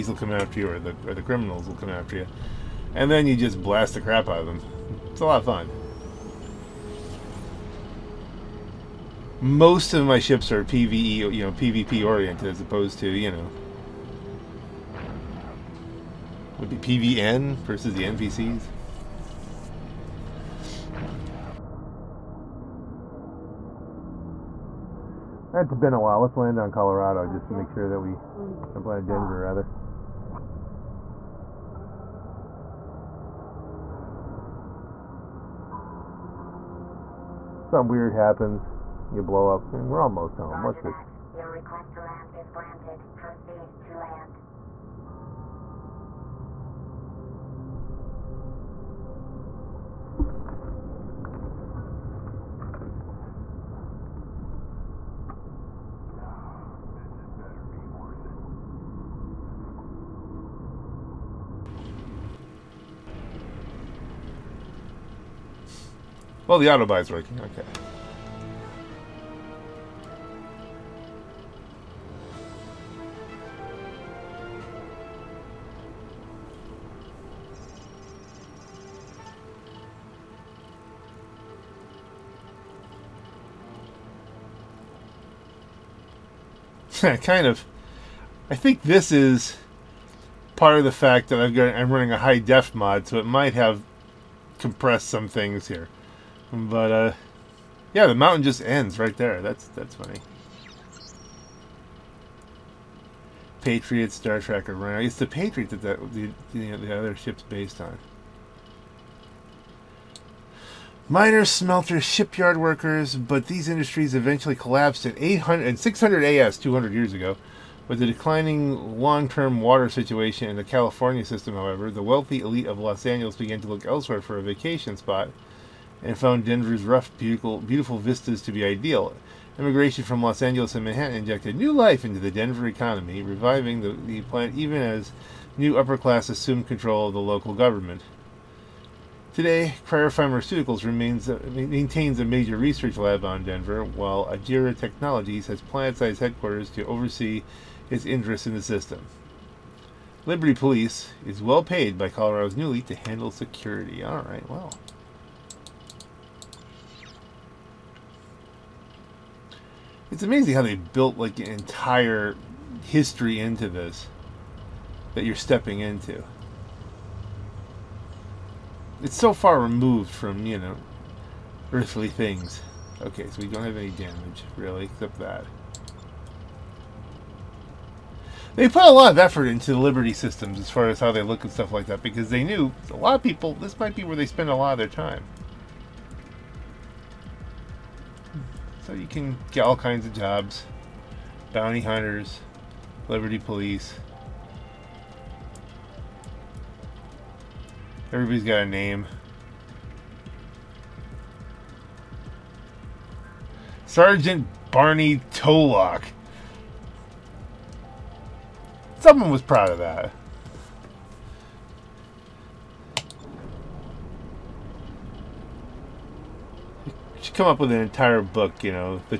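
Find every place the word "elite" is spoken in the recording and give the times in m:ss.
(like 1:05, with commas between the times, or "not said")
2:02, 2:32.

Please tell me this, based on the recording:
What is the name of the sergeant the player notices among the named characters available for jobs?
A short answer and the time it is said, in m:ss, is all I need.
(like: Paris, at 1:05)
Barney Tolock, at 3:24.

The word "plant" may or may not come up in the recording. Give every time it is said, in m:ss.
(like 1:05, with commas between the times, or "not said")
2:14, 2:25.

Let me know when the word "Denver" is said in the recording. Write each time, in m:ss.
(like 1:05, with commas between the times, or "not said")
0:28, 2:06, 2:12, 2:23.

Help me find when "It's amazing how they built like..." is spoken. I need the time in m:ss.
2:40.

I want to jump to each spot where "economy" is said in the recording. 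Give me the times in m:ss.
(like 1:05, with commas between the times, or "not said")
2:12.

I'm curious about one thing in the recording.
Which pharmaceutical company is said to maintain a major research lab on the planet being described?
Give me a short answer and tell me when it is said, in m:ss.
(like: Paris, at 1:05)
Cryer Pharmaceuticals, at 2:19.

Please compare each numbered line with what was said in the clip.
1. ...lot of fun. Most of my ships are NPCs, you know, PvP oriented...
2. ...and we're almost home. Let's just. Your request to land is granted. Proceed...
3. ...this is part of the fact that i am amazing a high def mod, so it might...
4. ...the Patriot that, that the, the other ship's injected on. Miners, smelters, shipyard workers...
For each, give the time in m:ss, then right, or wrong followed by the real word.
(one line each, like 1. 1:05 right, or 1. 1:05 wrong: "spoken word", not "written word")
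1. 0:05 wrong: "PVE", not "NPCs"
2. 0:39 right
3. 1:28 wrong: "running", not "amazing"
4. 1:45 wrong: "based", not "injected".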